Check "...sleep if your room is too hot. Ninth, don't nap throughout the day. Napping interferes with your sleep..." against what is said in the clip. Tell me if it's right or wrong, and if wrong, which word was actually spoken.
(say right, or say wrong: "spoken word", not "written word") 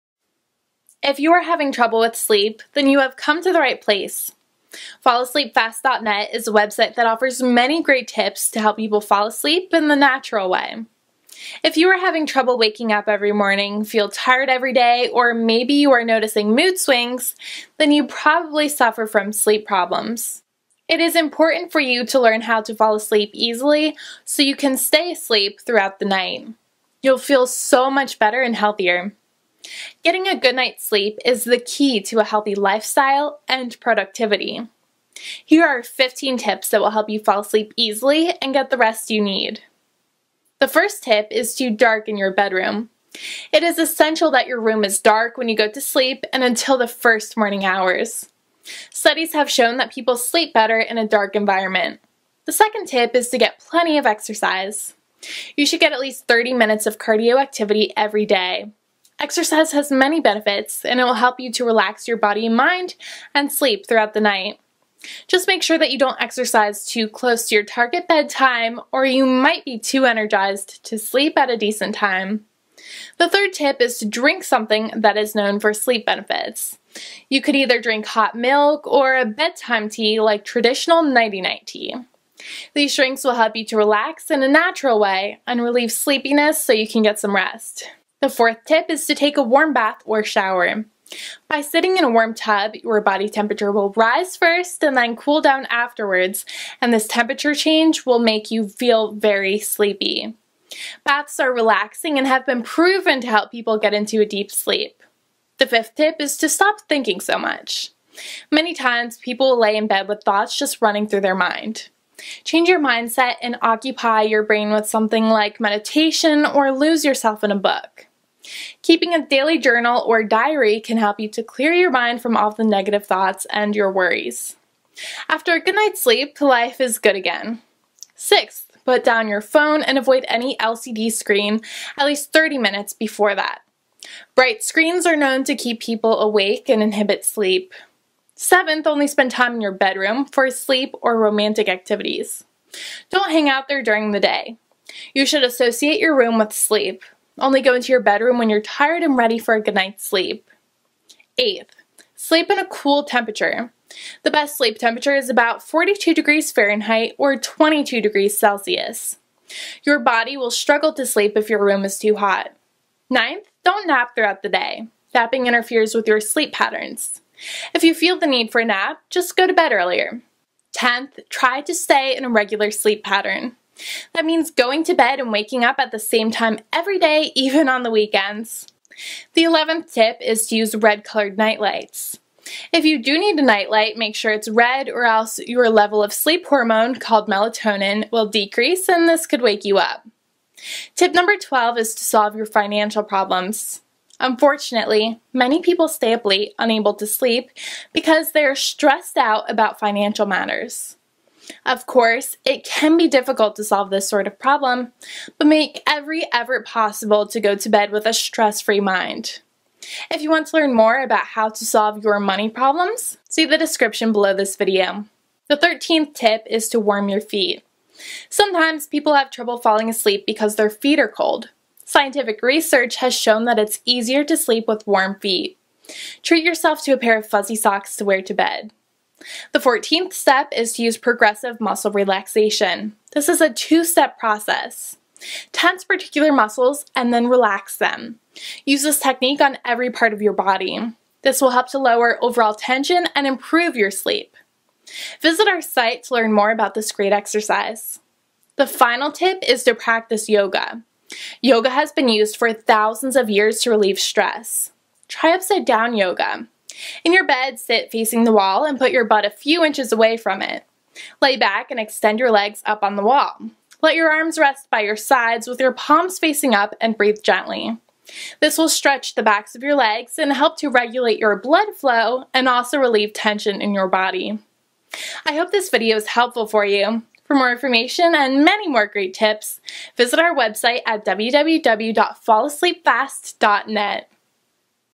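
right.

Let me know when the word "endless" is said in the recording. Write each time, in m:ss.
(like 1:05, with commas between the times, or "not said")
not said.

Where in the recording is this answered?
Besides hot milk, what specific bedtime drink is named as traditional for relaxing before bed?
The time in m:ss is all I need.
1:21.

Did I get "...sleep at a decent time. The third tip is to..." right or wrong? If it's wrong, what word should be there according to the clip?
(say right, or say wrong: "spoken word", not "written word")
right.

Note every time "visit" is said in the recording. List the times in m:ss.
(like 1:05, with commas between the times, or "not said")
4:05, 4:39.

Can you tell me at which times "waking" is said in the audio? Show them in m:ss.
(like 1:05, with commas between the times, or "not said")
0:12, 2:55.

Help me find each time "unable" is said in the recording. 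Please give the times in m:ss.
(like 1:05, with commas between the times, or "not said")
3:16.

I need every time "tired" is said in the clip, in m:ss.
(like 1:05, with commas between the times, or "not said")
0:14, 2:28.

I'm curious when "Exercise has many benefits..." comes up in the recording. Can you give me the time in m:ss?
0:59.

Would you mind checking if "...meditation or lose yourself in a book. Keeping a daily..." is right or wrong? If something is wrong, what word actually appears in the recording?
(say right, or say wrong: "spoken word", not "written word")
right.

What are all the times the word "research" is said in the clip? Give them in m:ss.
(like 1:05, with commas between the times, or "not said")
3:42.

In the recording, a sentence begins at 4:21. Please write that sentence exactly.
Lay back and extend your legs up on the wall.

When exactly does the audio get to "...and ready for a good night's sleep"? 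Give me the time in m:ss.
2:29.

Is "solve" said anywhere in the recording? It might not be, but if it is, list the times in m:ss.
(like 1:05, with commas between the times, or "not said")
3:12, 3:23, 3:31.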